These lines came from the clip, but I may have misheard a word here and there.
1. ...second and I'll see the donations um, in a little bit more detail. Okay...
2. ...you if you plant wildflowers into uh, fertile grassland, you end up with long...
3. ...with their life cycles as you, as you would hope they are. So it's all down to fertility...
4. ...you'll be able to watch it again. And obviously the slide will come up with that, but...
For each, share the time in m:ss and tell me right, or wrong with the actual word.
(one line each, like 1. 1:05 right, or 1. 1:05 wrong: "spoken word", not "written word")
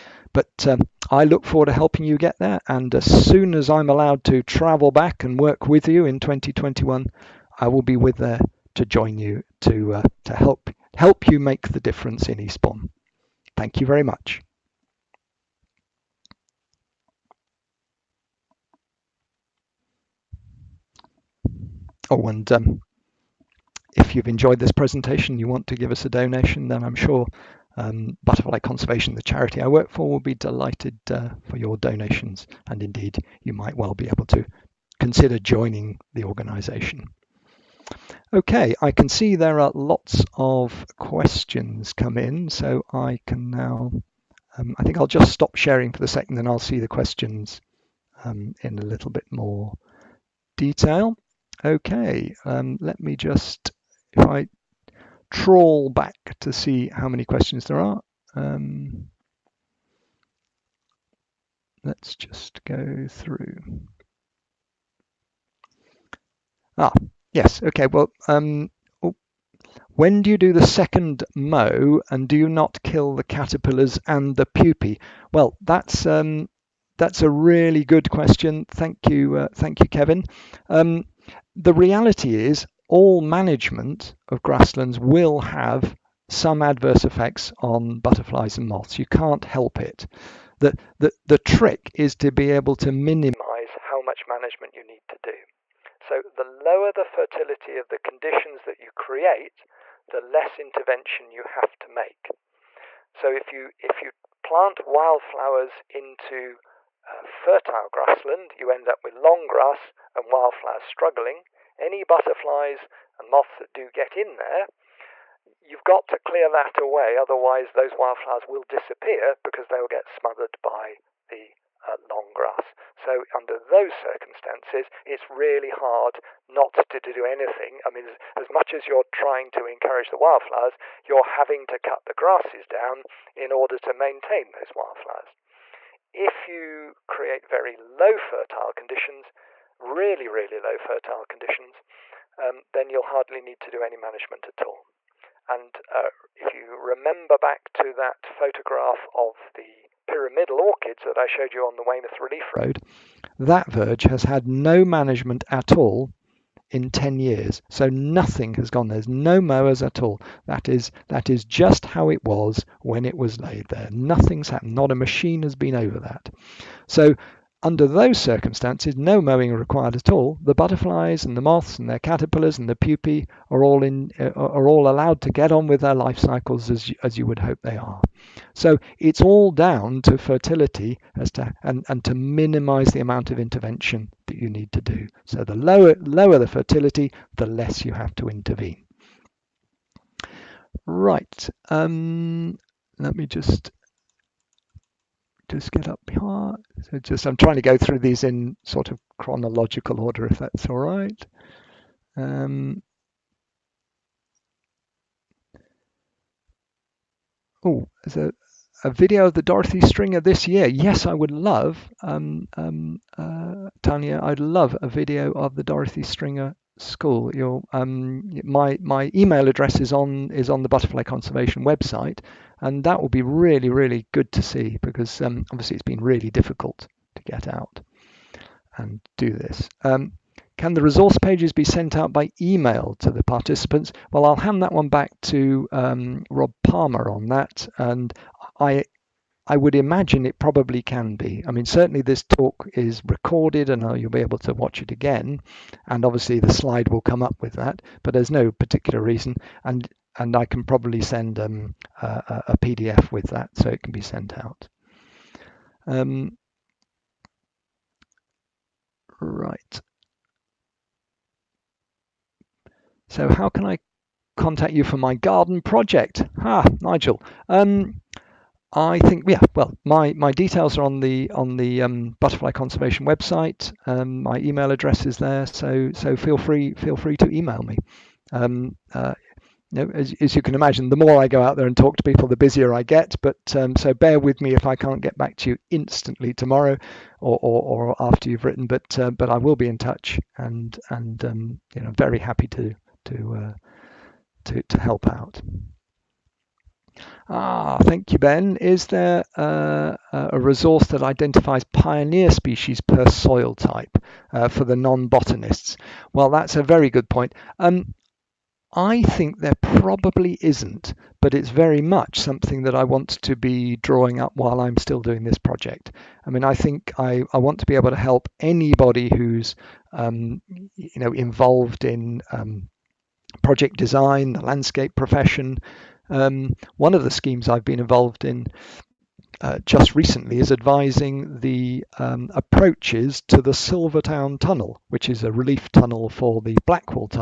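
1. 0:46 wrong: "questions", not "donations"
2. 1:43 right
3. 2:55 right
4. 4:03 right.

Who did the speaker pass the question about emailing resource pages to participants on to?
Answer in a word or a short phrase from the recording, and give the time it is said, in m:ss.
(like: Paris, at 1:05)
Rob Palmer, at 3:56.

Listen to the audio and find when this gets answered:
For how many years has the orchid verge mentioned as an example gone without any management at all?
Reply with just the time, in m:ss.
2:36.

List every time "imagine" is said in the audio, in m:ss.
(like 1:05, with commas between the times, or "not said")
3:59, 4:40.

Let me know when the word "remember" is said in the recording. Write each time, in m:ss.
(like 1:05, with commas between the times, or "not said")
2:26.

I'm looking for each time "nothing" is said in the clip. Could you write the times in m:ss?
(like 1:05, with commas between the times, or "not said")
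2:37, 2:43.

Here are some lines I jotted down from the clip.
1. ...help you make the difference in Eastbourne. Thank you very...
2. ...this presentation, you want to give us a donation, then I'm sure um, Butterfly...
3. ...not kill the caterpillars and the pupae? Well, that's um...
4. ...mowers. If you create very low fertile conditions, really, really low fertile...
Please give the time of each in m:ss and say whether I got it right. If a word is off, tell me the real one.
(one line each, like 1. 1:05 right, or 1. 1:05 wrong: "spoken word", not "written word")
1. 0:10 right
2. 0:24 right
3. 1:12 right
4. 2:14 wrong: "wildflowers", not "mowers".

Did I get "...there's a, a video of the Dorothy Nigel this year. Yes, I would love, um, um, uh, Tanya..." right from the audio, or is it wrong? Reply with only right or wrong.
wrong.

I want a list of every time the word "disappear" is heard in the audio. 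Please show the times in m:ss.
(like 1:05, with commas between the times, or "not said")
1:58.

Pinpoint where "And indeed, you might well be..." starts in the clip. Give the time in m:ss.
0:32.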